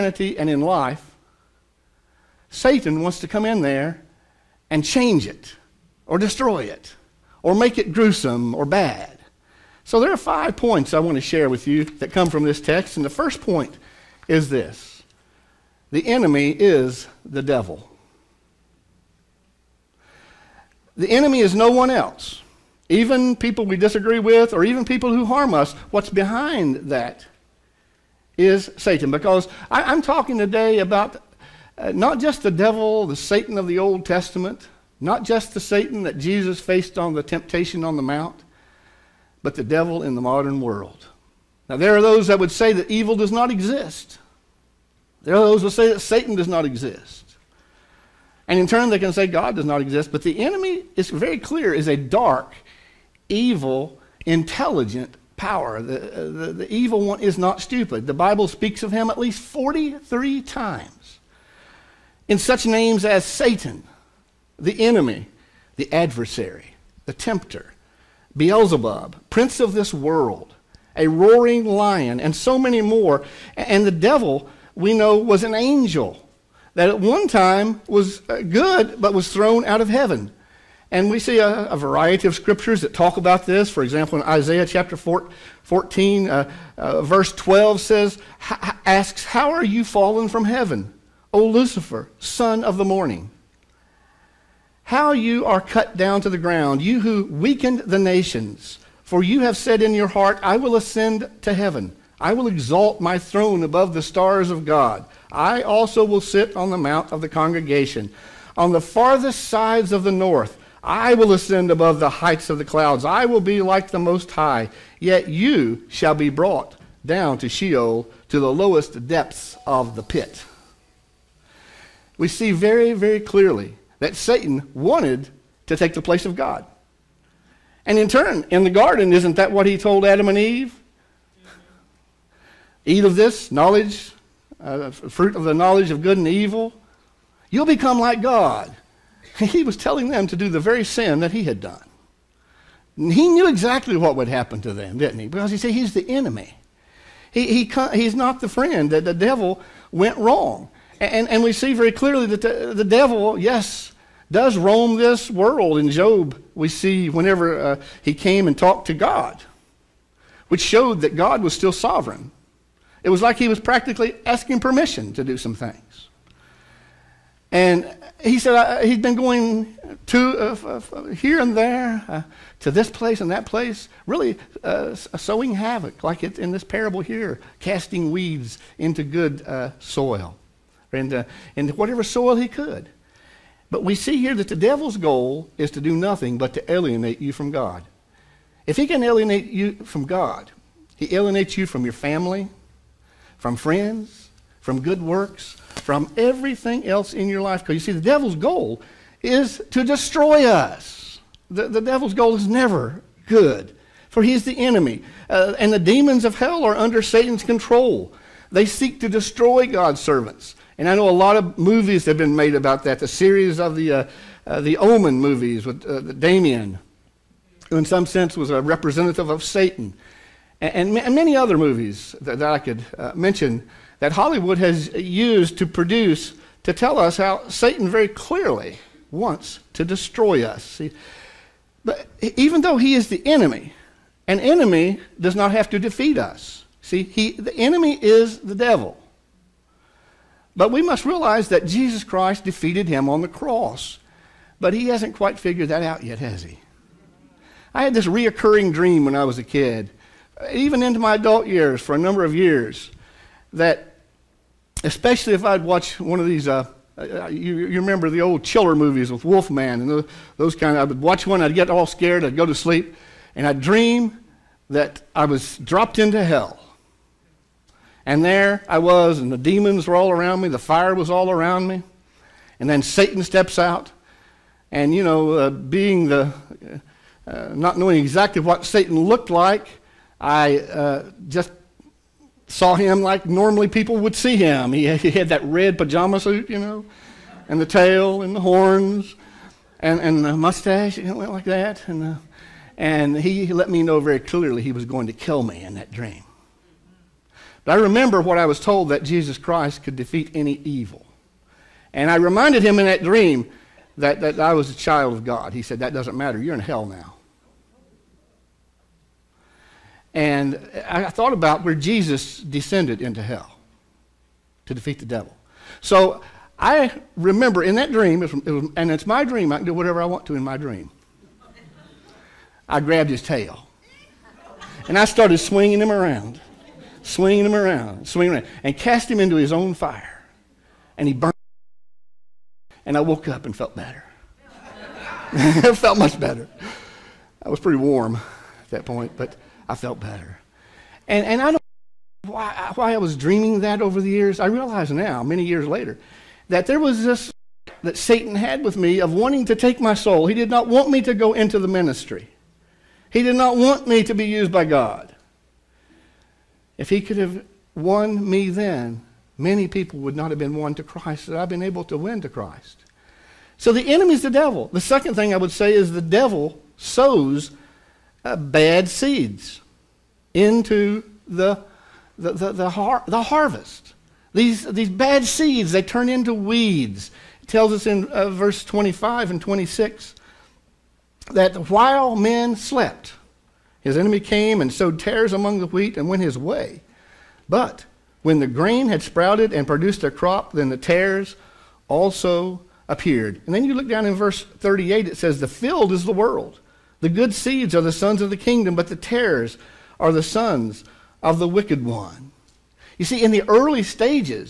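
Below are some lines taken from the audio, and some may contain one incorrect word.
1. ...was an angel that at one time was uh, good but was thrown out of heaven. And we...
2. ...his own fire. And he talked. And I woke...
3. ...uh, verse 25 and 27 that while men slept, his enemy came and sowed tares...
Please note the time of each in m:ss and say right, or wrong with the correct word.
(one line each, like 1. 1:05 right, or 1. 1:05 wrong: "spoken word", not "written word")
1. 1:15 right
2. 5:29 wrong: "burned", not "talked"
3. 6:18 wrong: "26", not "27".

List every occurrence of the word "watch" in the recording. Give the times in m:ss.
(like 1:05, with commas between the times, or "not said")
4:15, 4:21.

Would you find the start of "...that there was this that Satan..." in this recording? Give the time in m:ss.
5:46.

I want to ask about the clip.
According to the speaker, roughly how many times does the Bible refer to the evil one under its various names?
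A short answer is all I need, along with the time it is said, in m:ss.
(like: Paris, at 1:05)
43, at 0:59.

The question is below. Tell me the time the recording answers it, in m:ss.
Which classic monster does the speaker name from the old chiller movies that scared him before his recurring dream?
4:19.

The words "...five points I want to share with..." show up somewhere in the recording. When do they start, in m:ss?
0:10.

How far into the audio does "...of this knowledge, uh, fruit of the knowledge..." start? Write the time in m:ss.
2:13.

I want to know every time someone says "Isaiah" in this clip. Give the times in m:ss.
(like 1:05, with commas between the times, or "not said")
1:24.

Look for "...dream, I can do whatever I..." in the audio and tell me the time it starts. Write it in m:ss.
5:19.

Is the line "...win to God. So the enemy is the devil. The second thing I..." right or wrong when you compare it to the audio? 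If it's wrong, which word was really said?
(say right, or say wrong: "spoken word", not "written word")
wrong: "Christ", not "God".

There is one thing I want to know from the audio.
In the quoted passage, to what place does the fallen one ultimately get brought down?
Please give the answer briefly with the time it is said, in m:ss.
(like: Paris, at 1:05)
Sheol, at 1:57.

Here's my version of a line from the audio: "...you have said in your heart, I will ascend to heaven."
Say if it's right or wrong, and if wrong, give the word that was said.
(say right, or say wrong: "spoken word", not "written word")
right.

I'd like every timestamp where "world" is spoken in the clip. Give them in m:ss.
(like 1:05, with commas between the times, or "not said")
0:40, 1:09, 2:35, 6:36.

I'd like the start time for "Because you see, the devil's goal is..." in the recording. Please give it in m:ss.
3:17.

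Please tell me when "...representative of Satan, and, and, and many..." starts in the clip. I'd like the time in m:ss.
3:38.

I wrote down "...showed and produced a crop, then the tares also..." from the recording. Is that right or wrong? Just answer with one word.
wrong.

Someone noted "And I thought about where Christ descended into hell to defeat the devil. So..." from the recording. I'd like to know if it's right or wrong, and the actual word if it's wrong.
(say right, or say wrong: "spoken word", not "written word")
wrong: "Jesus", not "Christ".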